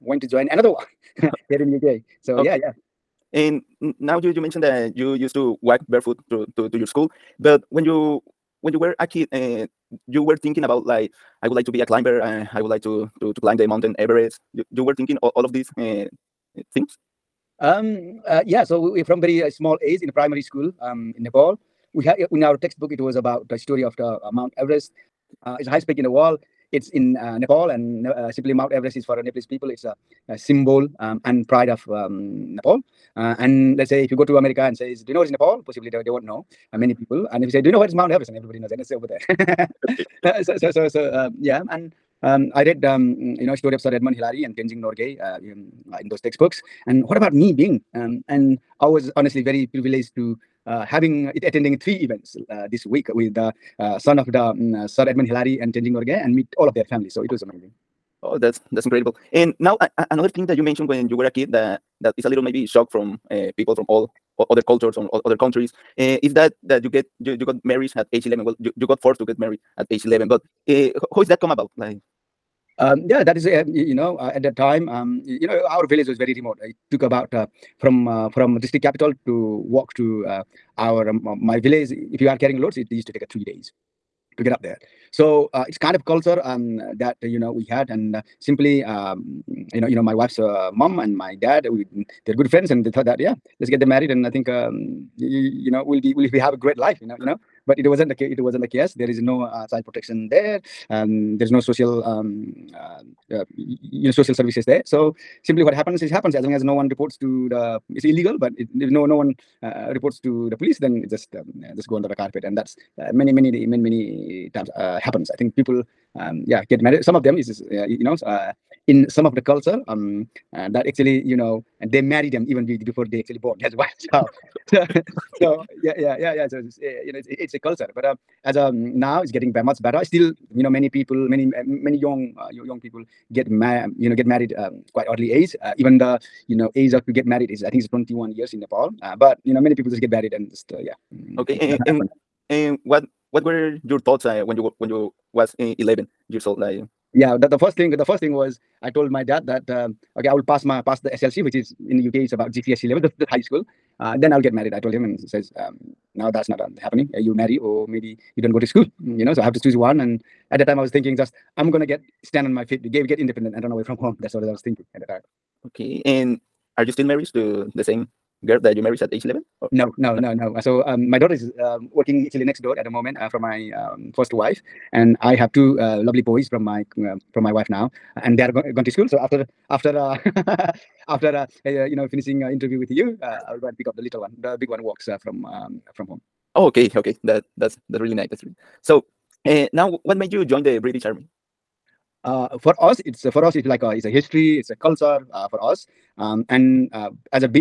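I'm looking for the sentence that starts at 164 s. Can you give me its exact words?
That's what I was thinking at that time.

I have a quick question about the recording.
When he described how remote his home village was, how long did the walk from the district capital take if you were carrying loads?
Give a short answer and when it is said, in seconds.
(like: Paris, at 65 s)
3 days, at 83 s.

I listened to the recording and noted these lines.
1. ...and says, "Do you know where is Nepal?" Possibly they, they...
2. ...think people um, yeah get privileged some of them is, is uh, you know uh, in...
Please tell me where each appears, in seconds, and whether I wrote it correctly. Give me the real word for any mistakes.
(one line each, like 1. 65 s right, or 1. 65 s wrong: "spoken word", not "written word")
1. 34 s right
2. 115 s wrong: "married", not "privileged".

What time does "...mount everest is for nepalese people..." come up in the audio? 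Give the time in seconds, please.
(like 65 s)
28 s.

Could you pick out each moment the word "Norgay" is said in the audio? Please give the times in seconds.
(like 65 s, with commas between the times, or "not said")
44 s, 55 s.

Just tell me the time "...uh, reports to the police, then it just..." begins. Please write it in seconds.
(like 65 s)
109 s.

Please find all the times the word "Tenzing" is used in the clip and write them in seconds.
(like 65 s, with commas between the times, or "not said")
44 s, 55 s.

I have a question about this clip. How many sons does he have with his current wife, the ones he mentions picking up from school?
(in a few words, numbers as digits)
2.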